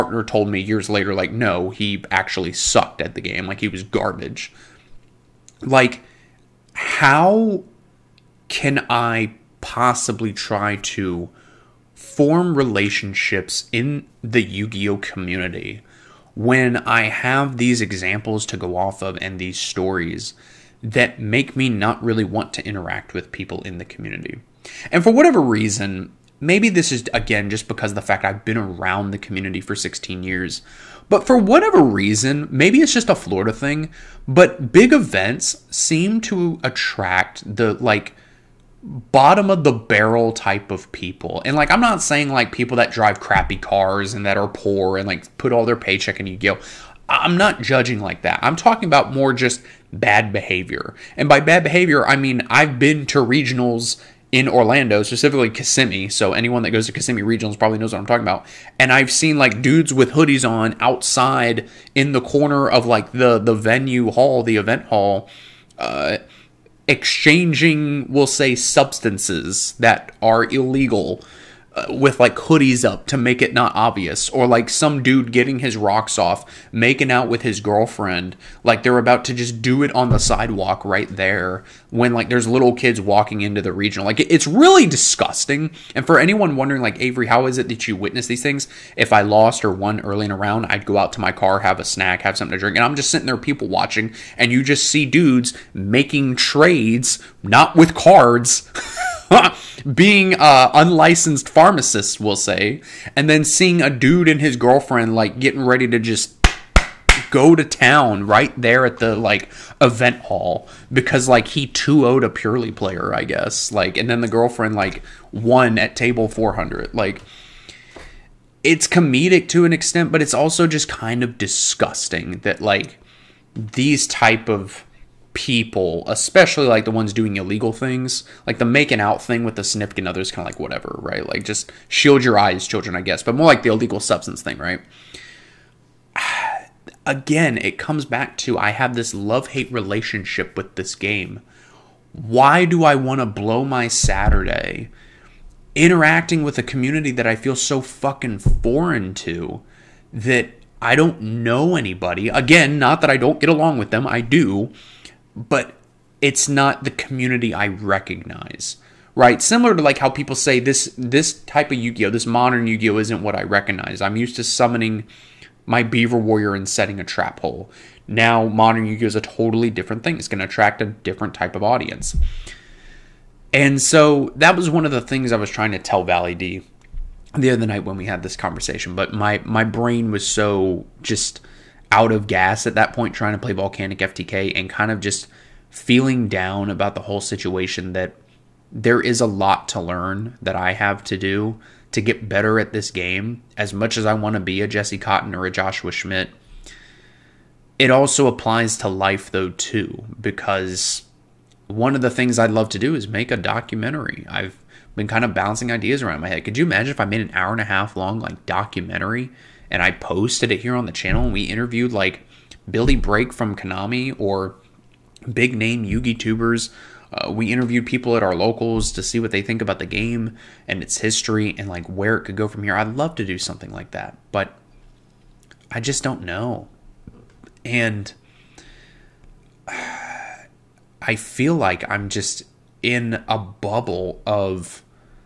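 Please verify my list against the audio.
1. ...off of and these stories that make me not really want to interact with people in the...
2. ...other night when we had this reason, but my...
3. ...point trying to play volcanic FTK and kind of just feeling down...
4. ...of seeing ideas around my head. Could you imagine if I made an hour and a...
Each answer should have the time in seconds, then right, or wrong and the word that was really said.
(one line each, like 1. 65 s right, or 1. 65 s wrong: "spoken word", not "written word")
1. 18 s right
2. 177 s wrong: "conversation", not "reason"
3. 182 s right
4. 205 s wrong: "bouncing", not "seeing".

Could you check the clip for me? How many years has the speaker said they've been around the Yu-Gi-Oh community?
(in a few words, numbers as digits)
16.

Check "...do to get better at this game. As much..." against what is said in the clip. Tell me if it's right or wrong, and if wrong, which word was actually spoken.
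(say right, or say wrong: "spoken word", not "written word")
right.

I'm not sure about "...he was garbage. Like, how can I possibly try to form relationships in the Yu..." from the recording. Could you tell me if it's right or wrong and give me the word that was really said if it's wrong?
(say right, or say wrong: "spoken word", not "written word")
right.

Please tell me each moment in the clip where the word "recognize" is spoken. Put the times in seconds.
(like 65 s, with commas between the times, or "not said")
157 s, 163 s.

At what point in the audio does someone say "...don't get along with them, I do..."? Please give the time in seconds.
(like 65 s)
153 s.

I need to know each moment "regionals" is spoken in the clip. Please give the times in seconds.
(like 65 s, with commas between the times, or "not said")
53 s, 57 s, 83 s.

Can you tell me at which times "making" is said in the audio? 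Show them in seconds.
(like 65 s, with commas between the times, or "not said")
76 s, 95 s, 128 s.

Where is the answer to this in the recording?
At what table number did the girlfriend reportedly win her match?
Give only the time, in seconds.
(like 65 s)
115 s.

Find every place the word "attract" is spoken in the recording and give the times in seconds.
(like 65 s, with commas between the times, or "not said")
36 s, 170 s.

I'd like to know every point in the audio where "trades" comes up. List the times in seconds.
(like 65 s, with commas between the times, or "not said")
96 s.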